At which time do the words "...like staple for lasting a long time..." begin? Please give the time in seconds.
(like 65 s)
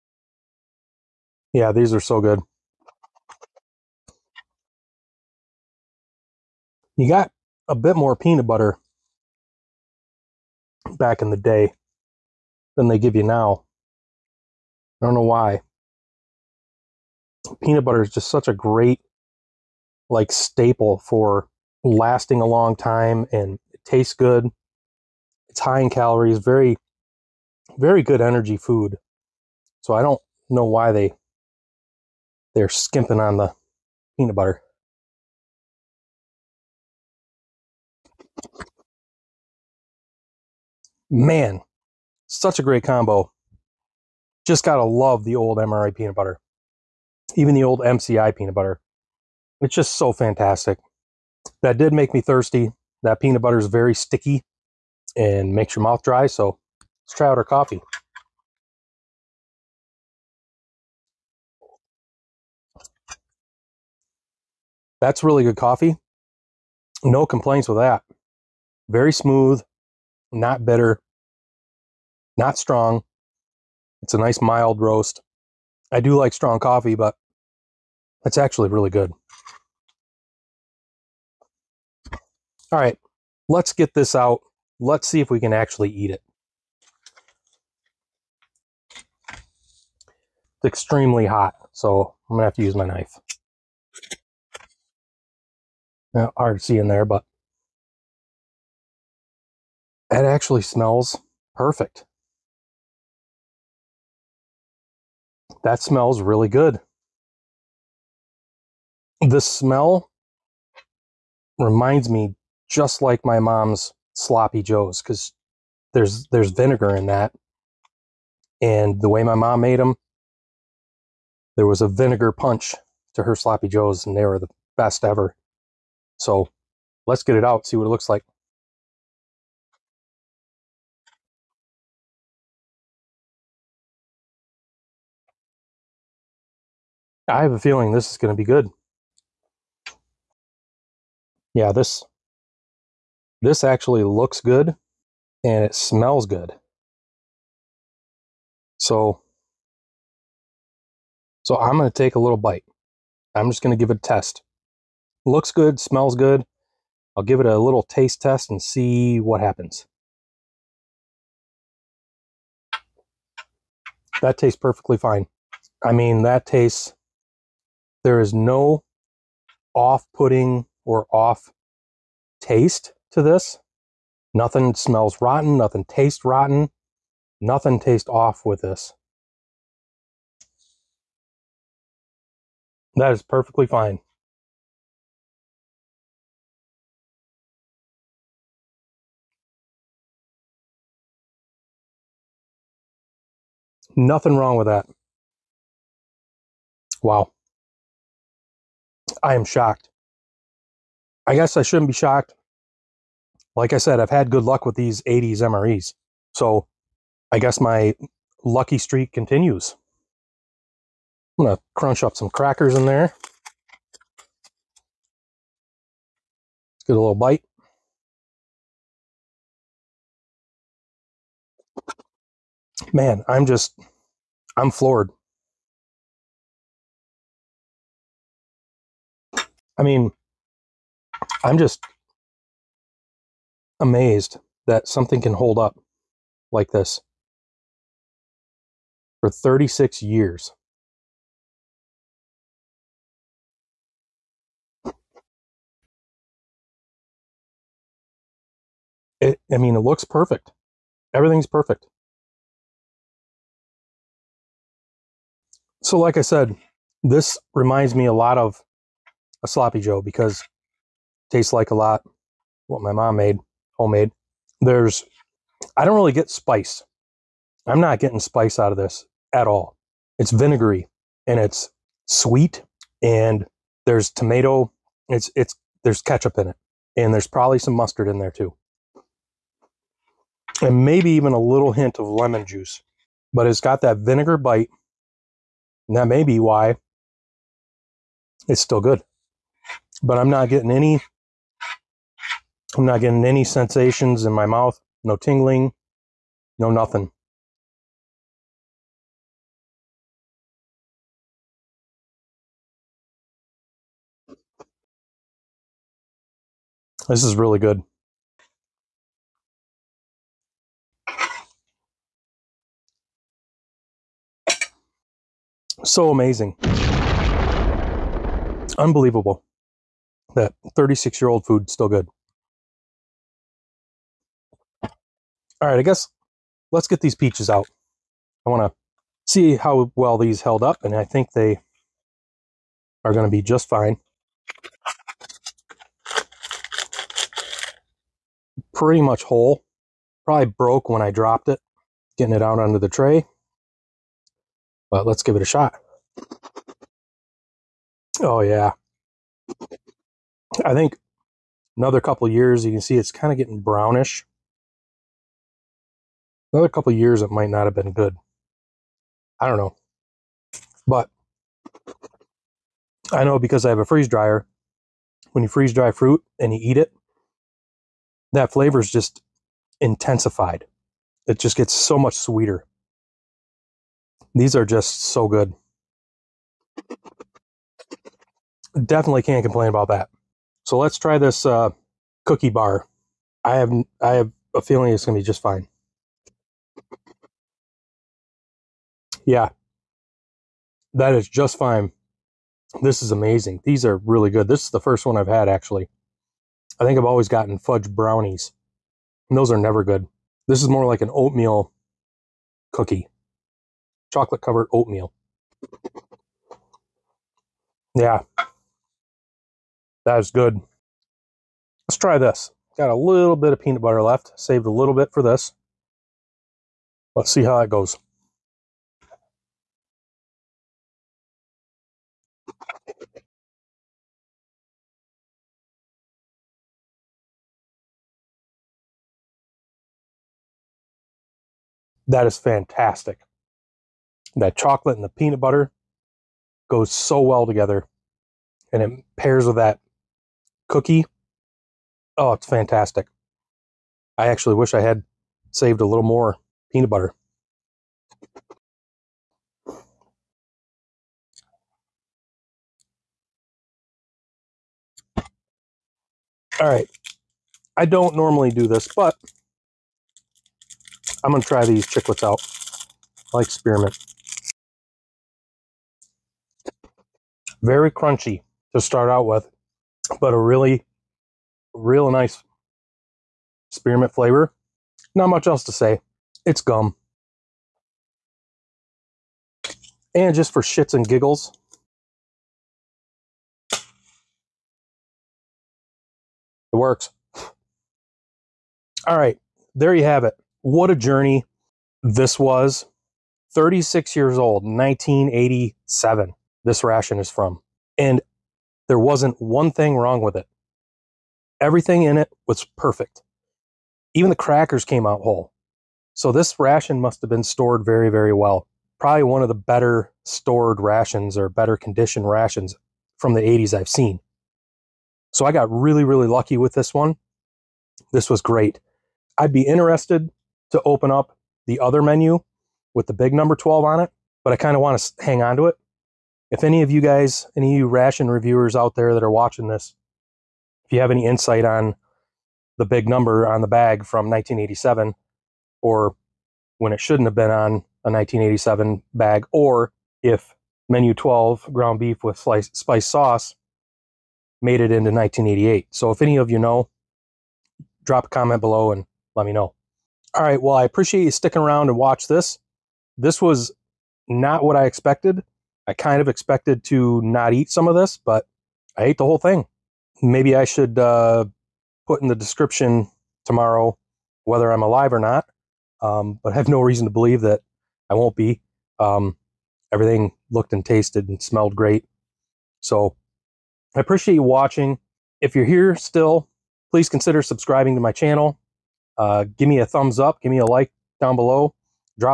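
20 s.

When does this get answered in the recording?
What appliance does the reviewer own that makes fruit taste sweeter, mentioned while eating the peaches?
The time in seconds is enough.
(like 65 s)
363 s.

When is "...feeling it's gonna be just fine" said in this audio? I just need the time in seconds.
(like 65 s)
384 s.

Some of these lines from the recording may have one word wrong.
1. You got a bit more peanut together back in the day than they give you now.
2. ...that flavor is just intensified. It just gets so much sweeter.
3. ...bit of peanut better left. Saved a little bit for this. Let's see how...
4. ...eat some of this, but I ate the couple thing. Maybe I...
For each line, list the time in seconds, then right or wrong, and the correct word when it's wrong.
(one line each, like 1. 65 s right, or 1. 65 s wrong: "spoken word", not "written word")
1. 6 s wrong: "butter", not "together"
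2. 368 s right
3. 413 s wrong: "butter", not "better"
4. 557 s wrong: "whole", not "couple".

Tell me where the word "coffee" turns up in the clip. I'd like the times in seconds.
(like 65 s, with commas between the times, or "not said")
57 s, 65 s, 76 s.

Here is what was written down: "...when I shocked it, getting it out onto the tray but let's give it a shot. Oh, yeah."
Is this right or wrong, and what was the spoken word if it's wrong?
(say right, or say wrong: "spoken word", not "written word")
wrong: "dropped", not "shocked".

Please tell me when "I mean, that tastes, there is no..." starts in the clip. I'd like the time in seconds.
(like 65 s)
165 s.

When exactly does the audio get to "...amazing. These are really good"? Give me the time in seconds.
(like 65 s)
393 s.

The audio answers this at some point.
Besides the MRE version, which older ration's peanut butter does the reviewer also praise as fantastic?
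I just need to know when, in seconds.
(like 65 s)
47 s.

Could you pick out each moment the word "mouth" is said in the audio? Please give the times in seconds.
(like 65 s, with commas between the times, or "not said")
55 s, 294 s.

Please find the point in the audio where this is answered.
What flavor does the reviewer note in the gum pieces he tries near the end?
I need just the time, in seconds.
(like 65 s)
473 s.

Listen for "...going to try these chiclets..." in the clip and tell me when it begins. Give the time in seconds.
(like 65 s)
461 s.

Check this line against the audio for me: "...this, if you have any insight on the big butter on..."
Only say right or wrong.
wrong.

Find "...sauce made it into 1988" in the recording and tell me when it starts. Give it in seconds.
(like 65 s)
543 s.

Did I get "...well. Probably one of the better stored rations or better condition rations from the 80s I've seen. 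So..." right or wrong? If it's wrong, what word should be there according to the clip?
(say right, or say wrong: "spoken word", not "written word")
right.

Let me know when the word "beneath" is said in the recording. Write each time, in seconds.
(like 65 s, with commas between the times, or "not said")
not said.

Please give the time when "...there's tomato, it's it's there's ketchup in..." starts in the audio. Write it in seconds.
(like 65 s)
273 s.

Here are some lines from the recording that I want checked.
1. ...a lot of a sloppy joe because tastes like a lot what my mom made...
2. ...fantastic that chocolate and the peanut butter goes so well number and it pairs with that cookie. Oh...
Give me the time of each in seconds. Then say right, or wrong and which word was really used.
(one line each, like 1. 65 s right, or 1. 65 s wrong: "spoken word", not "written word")
1. 258 s right
2. 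432 s wrong: "together", not "number".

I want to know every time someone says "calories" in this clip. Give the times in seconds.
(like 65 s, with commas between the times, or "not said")
25 s.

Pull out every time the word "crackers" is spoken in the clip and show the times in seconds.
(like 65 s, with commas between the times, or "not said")
212 s, 504 s.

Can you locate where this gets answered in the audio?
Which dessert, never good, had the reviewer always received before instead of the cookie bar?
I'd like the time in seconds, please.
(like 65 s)
397 s.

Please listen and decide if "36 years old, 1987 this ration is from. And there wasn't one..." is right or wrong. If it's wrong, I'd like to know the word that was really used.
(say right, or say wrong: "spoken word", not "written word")
right.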